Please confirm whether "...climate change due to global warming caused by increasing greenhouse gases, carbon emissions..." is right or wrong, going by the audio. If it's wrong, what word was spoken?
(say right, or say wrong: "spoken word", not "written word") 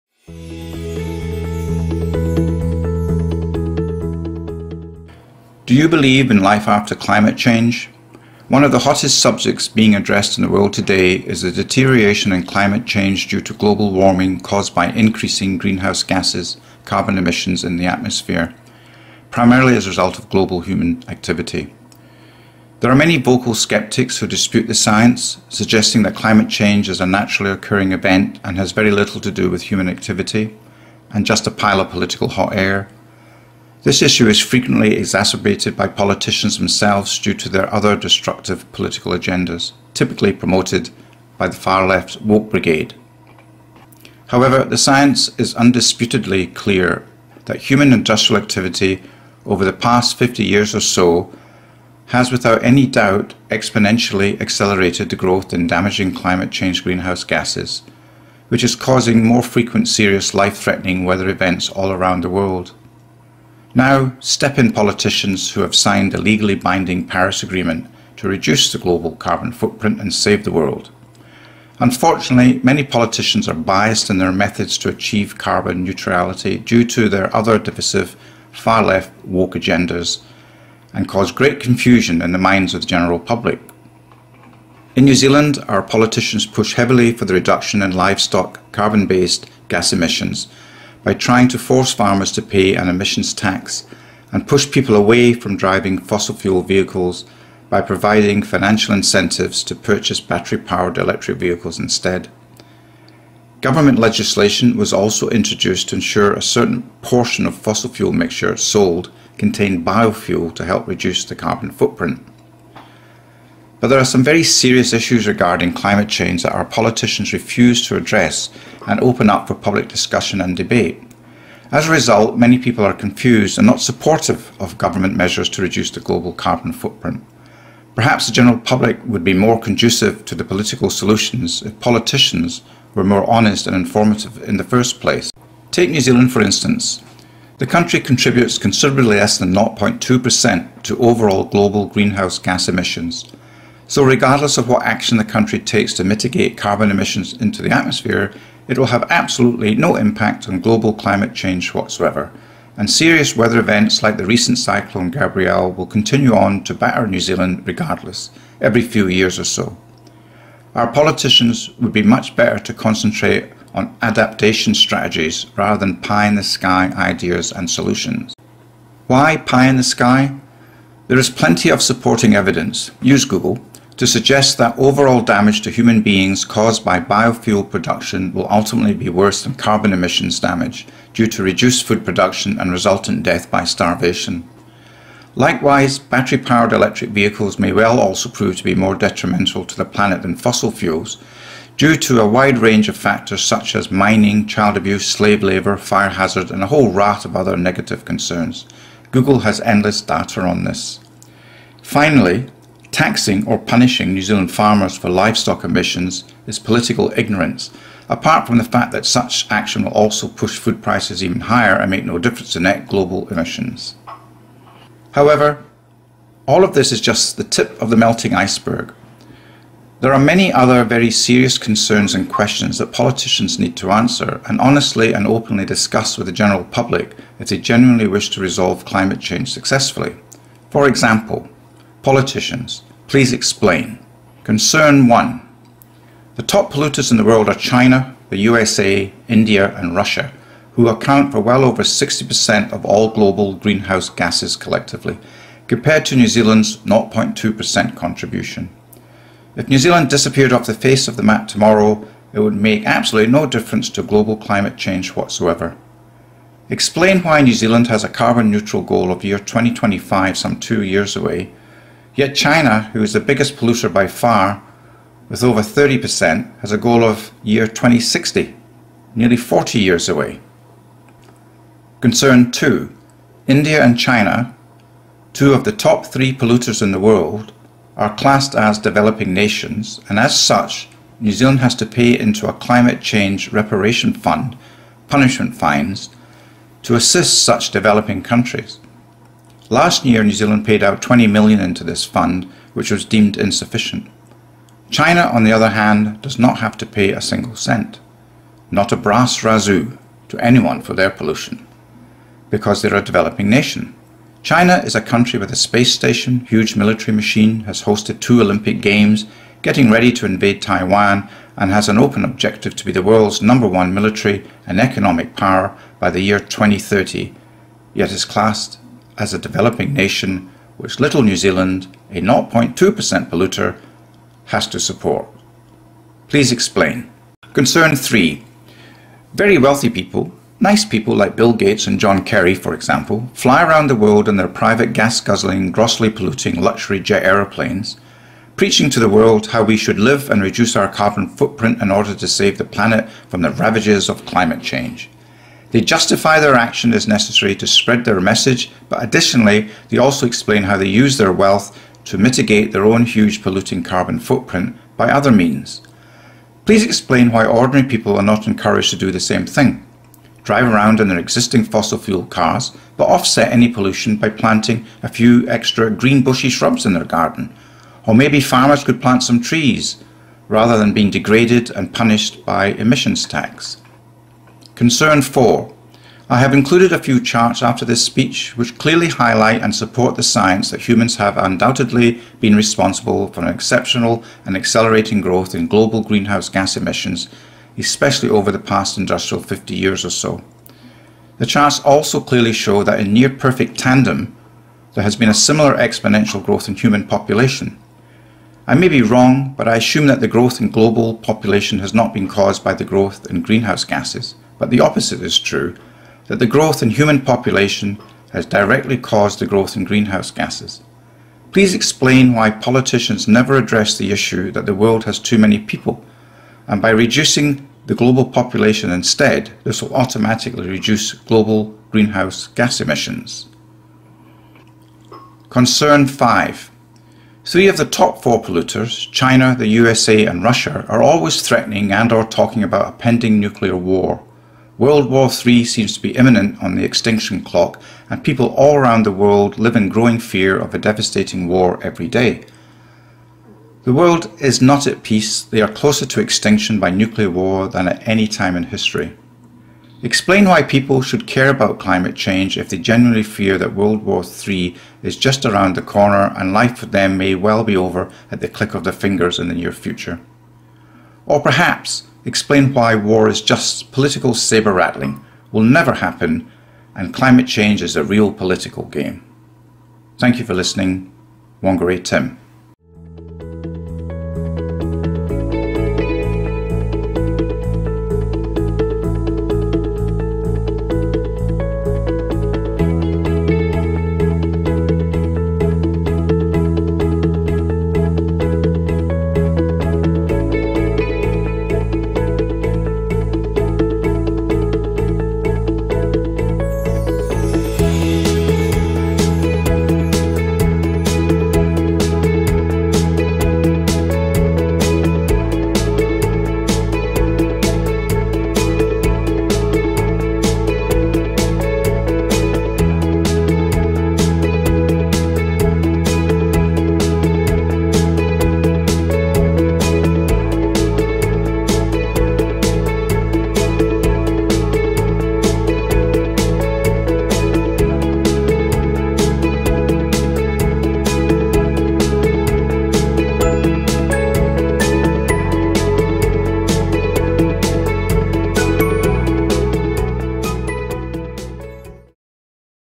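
right.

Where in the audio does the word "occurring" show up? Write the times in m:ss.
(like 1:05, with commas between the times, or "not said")
0:27.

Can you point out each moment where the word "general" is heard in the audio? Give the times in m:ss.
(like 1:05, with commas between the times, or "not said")
1:22, 2:08, 3:46.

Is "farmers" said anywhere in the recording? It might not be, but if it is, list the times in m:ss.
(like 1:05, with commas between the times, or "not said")
1:31, 3:24, 6:08.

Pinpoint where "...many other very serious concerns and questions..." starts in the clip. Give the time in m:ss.
3:40.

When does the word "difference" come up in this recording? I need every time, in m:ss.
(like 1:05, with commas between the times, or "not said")
3:32, 4:13.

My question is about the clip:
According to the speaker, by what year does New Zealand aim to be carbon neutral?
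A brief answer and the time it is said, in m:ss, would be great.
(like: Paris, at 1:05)
2025, at 4:19.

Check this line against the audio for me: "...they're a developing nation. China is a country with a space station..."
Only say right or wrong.
right.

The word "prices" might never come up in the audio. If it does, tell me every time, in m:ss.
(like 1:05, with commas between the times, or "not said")
3:30.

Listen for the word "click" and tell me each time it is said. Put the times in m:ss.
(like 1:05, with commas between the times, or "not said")
7:38.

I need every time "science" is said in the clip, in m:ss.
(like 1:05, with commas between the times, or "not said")
0:24, 0:44, 6:20.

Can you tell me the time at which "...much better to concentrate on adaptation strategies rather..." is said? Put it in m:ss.
2:42.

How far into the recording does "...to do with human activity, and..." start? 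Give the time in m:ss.
0:29.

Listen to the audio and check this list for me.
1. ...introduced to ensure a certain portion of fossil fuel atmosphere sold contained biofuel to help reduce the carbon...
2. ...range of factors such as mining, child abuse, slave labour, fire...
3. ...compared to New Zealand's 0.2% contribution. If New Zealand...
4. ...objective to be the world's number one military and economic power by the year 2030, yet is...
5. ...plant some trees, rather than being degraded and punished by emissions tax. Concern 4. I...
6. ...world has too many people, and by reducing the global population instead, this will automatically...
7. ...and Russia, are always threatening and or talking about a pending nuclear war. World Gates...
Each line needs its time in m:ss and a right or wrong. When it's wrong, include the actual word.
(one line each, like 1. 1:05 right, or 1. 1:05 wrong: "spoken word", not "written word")
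1. 1:45 wrong: "mixture", not "atmosphere"
2. 3:12 right
3. 4:05 right
4. 5:12 right
5. 6:09 right
6. 6:54 right
7. 7:10 wrong: "War", not "Gates".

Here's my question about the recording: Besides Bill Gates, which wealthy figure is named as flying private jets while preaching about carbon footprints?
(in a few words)
John Kerry.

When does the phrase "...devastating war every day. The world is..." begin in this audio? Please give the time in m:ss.
7:20.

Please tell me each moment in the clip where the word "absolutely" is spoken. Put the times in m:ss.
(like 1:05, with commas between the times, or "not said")
2:29, 4:12.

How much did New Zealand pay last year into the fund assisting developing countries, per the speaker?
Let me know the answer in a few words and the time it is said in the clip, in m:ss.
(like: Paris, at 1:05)
20 million, at 4:51.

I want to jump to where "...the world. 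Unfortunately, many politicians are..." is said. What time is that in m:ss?
1:10.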